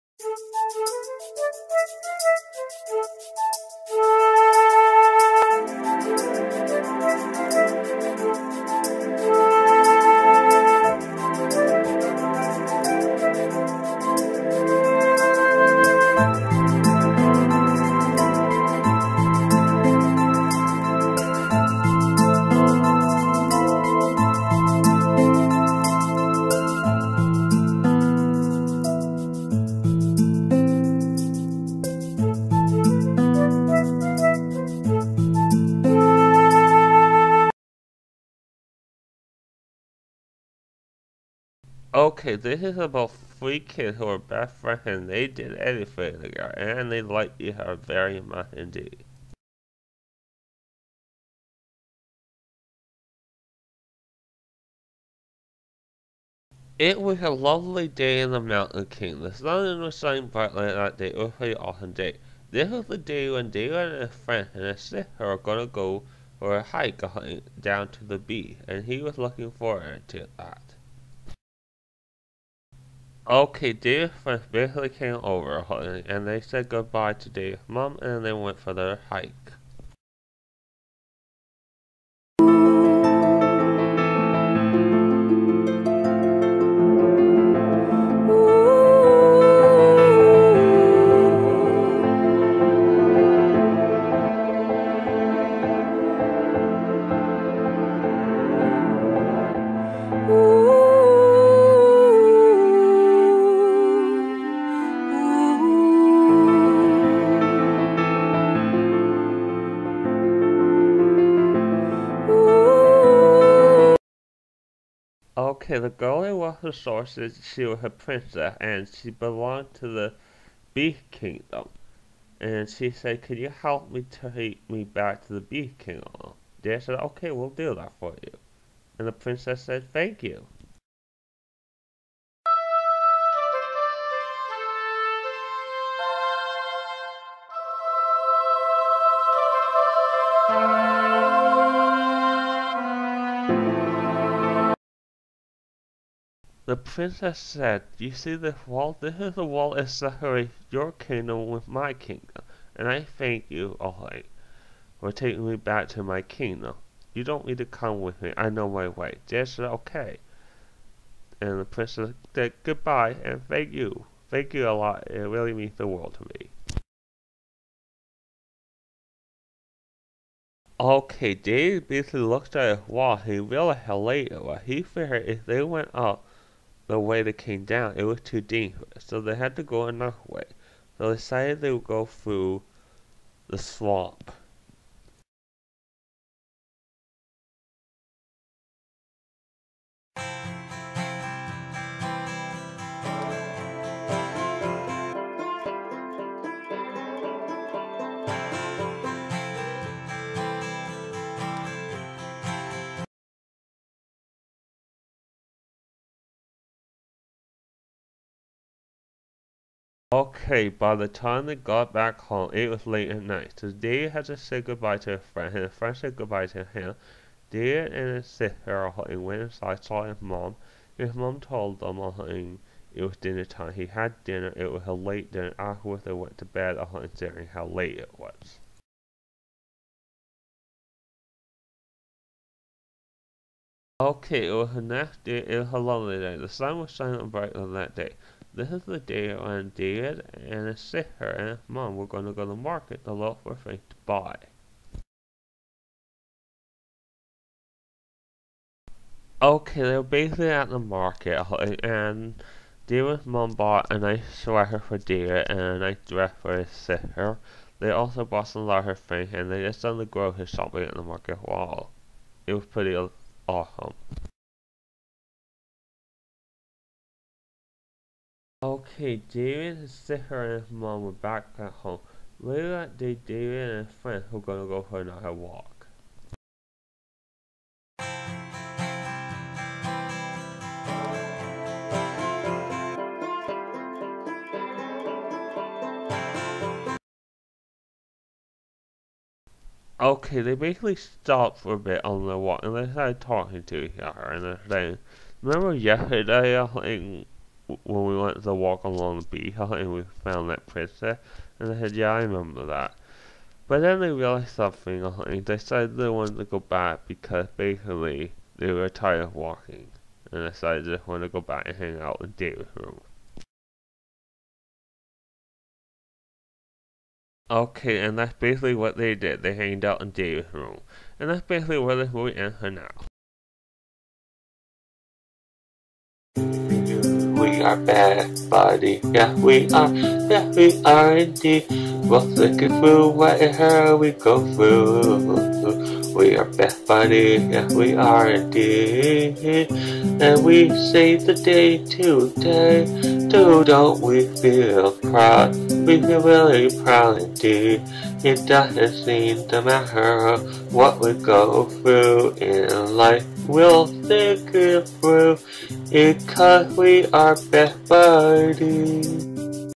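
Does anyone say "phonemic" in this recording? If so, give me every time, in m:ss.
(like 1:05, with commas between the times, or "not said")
not said.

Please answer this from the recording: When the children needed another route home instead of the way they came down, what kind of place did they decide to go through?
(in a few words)
the swamp.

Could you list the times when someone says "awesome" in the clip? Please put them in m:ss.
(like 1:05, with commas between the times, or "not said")
1:01, 4:23.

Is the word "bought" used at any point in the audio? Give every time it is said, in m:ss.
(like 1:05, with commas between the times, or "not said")
4:13, 4:18.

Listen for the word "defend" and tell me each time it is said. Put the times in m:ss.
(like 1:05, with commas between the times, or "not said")
not said.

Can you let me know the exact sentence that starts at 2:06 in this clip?
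They said, Okay, we'll do that for you.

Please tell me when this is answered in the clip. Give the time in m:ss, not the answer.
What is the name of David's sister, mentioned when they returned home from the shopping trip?
4:29.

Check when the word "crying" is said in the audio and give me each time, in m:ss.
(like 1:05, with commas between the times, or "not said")
not said.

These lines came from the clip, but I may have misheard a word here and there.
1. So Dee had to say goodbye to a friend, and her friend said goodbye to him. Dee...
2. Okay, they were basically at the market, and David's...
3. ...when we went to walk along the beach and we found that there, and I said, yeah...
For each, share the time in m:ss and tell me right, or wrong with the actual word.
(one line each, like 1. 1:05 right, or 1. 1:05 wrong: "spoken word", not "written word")
1. 3:33 right
2. 4:09 right
3. 4:57 right.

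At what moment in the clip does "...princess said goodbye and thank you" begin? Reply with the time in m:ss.
2:41.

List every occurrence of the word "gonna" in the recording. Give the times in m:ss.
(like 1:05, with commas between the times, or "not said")
1:05, 4:34.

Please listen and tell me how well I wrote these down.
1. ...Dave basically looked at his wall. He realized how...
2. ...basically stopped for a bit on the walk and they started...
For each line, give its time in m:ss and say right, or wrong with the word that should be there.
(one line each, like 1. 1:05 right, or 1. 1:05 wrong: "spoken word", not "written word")
1. 2:51 right
2. 4:50 right.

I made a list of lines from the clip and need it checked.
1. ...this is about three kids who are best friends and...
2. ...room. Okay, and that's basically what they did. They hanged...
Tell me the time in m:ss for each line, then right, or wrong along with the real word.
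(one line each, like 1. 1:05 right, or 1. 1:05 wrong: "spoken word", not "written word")
1. 0:42 right
2. 5:12 right.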